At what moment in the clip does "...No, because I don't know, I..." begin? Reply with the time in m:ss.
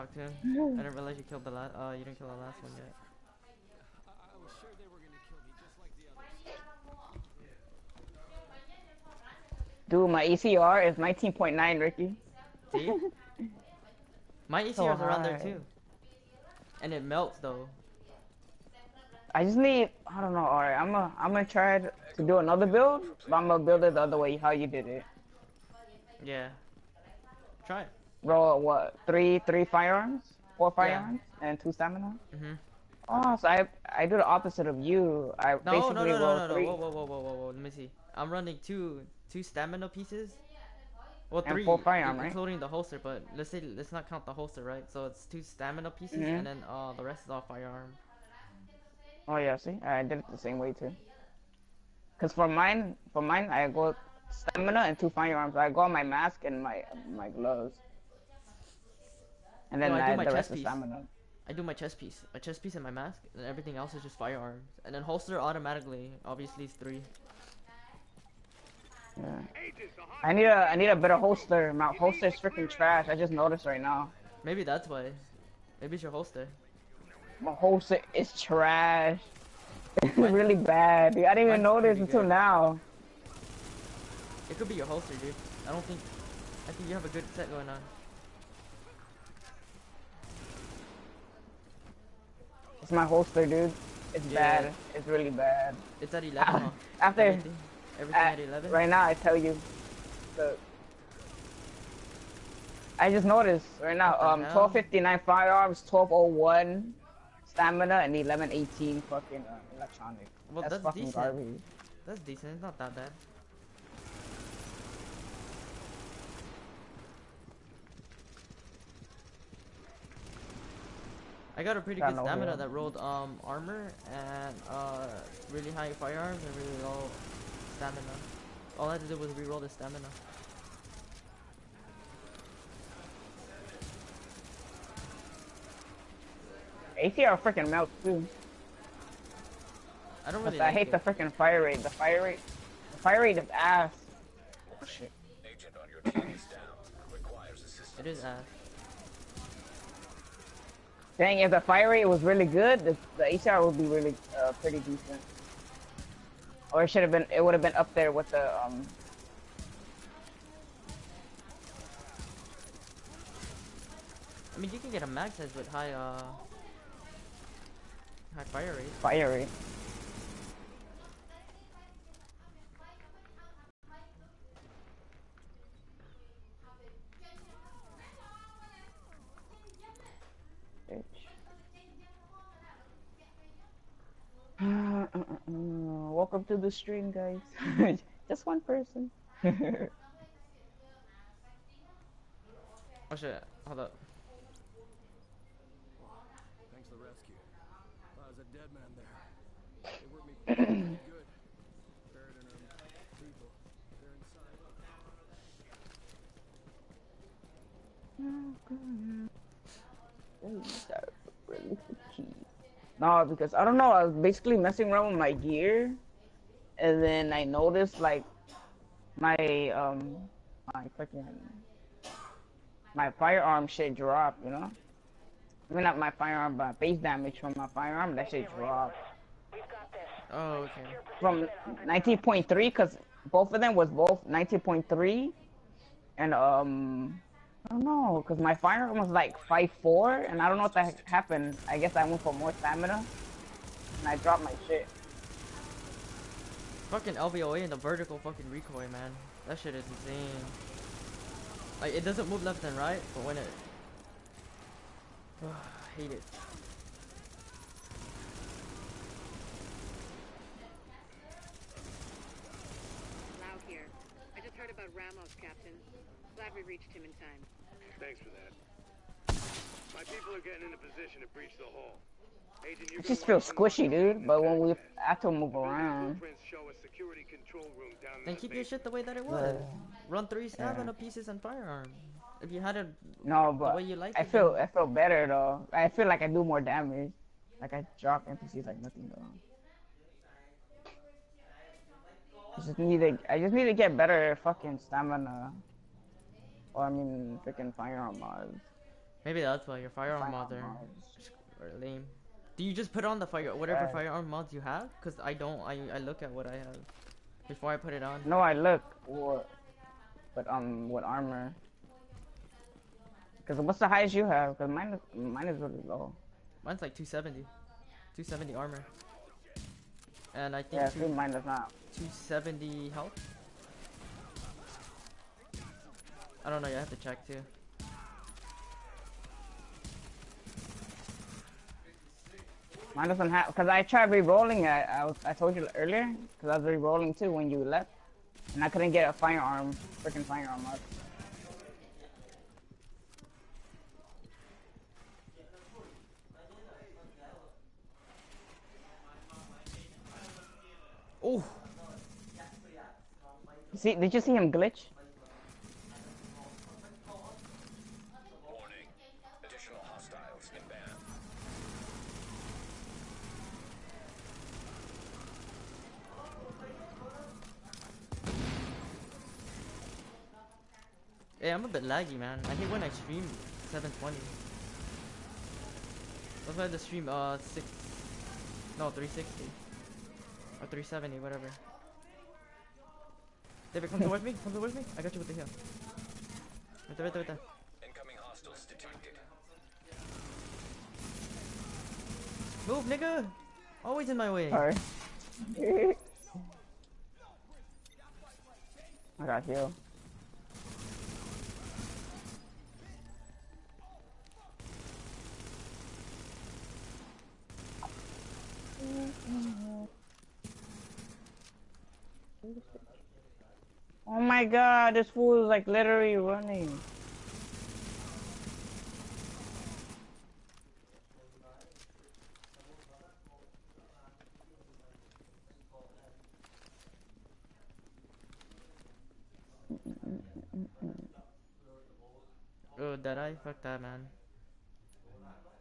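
3:32.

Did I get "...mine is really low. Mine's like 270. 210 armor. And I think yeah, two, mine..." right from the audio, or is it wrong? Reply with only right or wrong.
wrong.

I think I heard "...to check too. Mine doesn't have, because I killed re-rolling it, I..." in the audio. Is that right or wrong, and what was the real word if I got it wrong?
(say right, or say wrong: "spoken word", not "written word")
wrong: "tried", not "killed".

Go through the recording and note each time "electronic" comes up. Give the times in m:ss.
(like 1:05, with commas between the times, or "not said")
1:49.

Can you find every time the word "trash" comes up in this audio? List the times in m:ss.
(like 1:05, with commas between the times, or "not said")
1:12, 1:18.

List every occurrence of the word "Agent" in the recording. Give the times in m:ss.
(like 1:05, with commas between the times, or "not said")
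2:25, 4:32.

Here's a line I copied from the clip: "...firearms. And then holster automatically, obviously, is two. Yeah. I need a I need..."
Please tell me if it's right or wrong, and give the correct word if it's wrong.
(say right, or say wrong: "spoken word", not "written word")
wrong: "three", not "two".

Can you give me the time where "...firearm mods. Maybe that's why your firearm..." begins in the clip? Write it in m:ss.
4:57.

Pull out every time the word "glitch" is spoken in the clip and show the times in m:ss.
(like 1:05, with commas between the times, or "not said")
5:54.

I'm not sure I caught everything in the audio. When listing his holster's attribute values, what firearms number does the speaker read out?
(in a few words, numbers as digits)
1259.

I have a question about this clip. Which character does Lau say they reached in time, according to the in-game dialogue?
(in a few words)
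Ramos.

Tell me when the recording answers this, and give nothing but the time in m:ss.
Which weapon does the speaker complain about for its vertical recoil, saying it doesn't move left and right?
4:07.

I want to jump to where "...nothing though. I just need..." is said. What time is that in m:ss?
4:48.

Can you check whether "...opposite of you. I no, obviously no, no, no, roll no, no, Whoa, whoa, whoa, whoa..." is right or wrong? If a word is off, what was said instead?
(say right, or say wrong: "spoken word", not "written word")
wrong: "basically", not "obviously".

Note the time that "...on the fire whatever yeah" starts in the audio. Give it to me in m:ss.
5:03.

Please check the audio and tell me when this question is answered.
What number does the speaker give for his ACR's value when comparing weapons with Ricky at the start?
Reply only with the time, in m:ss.
0:10.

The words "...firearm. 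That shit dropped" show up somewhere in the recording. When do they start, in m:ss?
3:47.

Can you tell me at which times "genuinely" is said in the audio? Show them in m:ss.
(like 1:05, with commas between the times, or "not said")
not said.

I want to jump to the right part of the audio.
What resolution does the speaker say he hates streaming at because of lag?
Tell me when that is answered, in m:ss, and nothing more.
6:13.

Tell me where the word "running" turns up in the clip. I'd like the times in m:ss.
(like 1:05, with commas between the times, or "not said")
0:38, 6:56.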